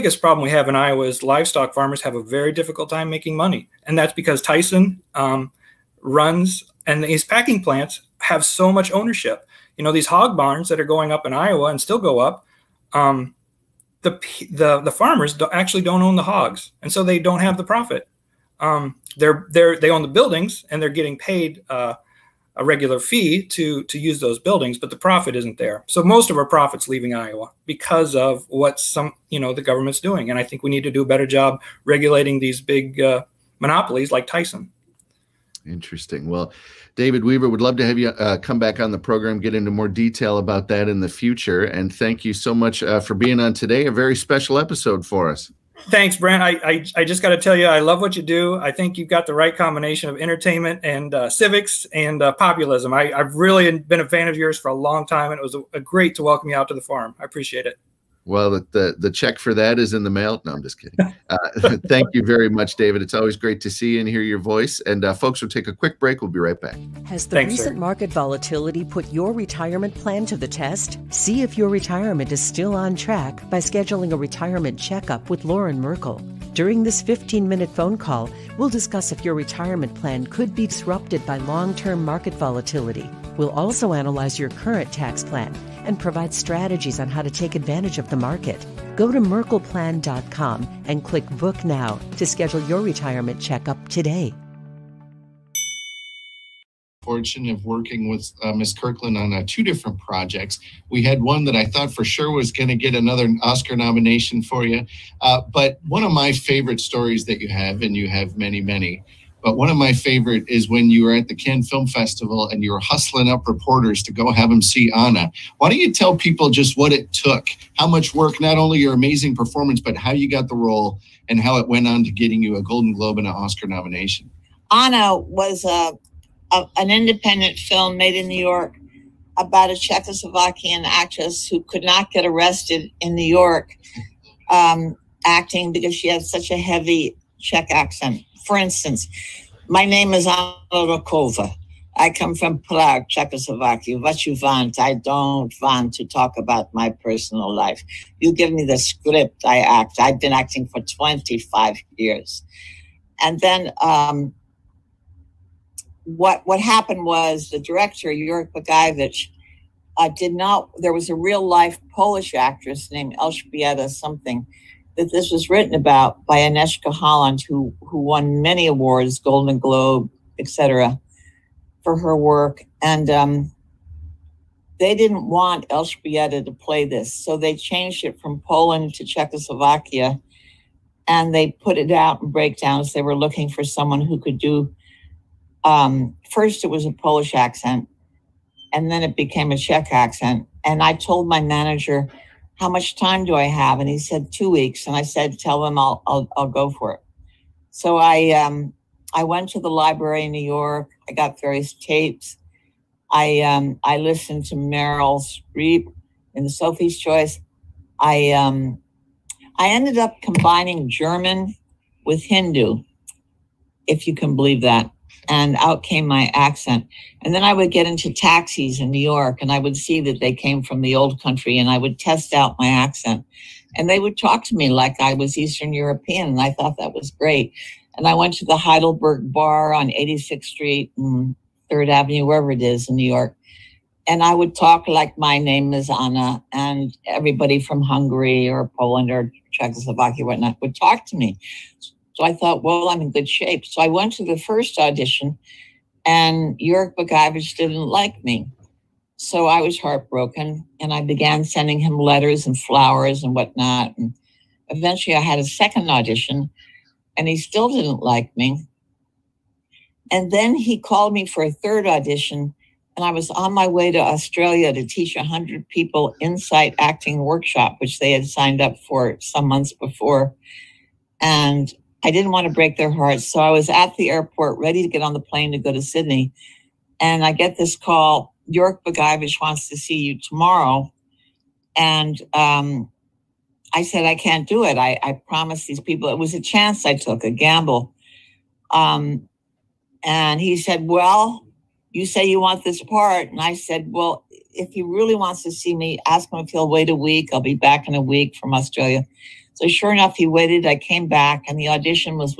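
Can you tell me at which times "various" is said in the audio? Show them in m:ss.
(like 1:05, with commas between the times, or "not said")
3:21.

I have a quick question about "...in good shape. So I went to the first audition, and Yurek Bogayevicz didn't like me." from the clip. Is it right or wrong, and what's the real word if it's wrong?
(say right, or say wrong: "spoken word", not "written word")
right.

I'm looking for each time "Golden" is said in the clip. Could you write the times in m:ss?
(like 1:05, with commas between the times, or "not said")
2:02, 2:49.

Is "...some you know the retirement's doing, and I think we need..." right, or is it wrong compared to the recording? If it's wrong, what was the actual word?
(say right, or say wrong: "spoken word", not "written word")
wrong: "government", not "retirement".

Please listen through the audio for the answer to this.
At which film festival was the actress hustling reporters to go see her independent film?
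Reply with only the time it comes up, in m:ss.
1:51.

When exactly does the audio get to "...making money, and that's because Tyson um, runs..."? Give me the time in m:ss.
0:03.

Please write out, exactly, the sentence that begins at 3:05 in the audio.
Um, first, it was a Polish accent, and then it became a Czech accent.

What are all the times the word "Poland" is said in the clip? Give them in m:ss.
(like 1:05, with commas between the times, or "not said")
2:58, 3:58.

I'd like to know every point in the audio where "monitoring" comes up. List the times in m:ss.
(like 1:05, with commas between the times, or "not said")
not said.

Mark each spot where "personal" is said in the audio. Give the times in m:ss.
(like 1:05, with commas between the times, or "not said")
2:26.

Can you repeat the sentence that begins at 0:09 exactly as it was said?
You know these hog barns that are going up in Iowa and still go up.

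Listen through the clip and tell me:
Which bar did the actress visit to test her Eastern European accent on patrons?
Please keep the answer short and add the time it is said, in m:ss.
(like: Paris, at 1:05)
Heidelberg Bar, at 3:48.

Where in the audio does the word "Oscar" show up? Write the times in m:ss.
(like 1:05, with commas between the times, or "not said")
1:43, 2:03.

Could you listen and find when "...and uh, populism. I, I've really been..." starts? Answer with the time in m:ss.
0:51.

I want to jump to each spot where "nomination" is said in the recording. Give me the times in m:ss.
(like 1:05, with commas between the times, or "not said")
1:43, 2:03.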